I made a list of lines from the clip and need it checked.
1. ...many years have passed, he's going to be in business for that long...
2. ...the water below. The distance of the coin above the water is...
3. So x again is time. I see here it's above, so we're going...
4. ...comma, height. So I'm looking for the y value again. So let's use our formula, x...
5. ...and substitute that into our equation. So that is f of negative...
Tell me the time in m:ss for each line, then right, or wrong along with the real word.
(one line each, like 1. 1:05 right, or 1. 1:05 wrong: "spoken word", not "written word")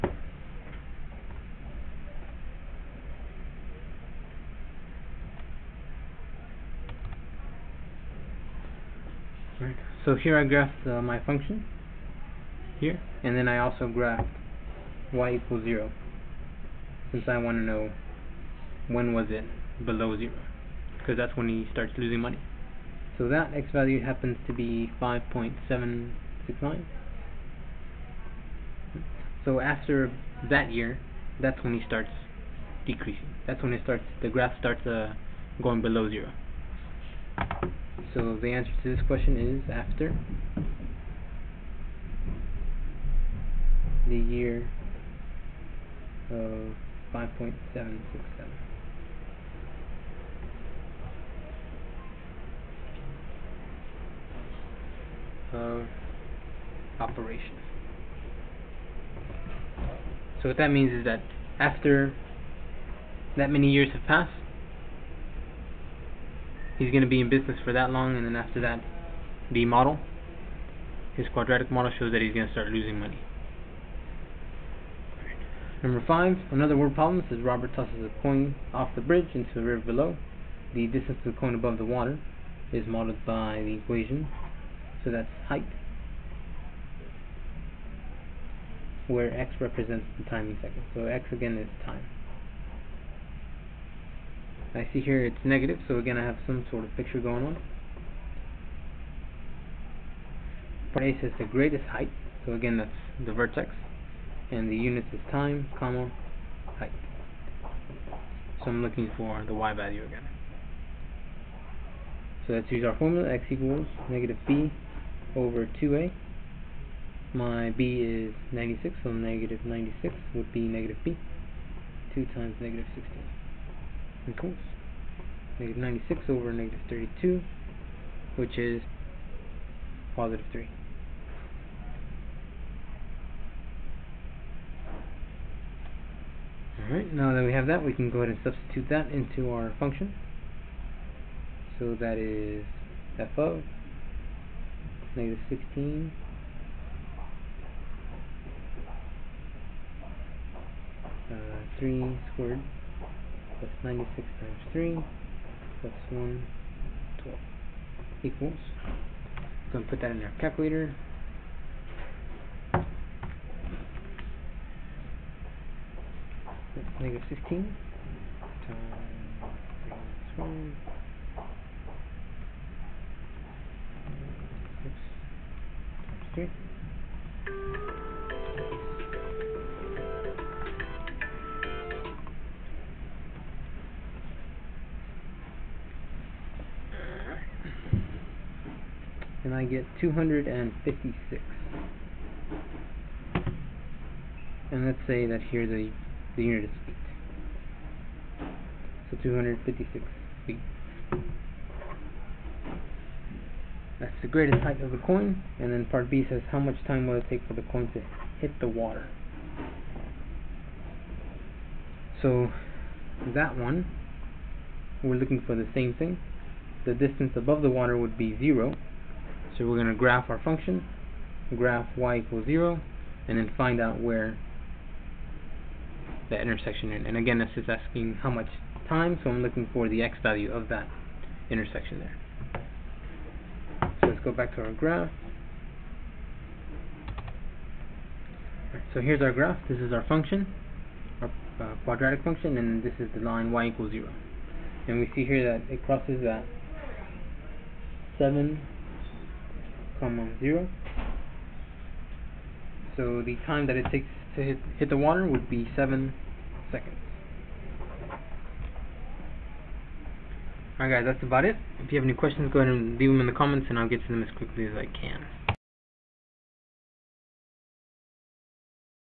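1. 1:03 right
2. 1:19 wrong: "river", not "water"
3. 1:30 wrong: "negative", not "above"
4. 1:45 right
5. 2:18 wrong: "function", not "equation".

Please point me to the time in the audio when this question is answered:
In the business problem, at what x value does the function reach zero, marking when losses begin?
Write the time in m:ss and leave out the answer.
0:25.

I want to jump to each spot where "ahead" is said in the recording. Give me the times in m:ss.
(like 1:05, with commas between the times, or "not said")
2:18, 4:22.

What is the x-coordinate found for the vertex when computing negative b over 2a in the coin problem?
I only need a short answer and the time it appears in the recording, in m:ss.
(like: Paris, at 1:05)
3, at 2:10.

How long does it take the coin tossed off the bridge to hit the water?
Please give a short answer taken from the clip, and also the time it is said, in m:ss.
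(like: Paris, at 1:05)
7 seconds, at 4:15.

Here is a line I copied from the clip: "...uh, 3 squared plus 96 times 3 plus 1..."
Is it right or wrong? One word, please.
right.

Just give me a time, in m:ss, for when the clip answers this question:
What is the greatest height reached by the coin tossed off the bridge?
3:19.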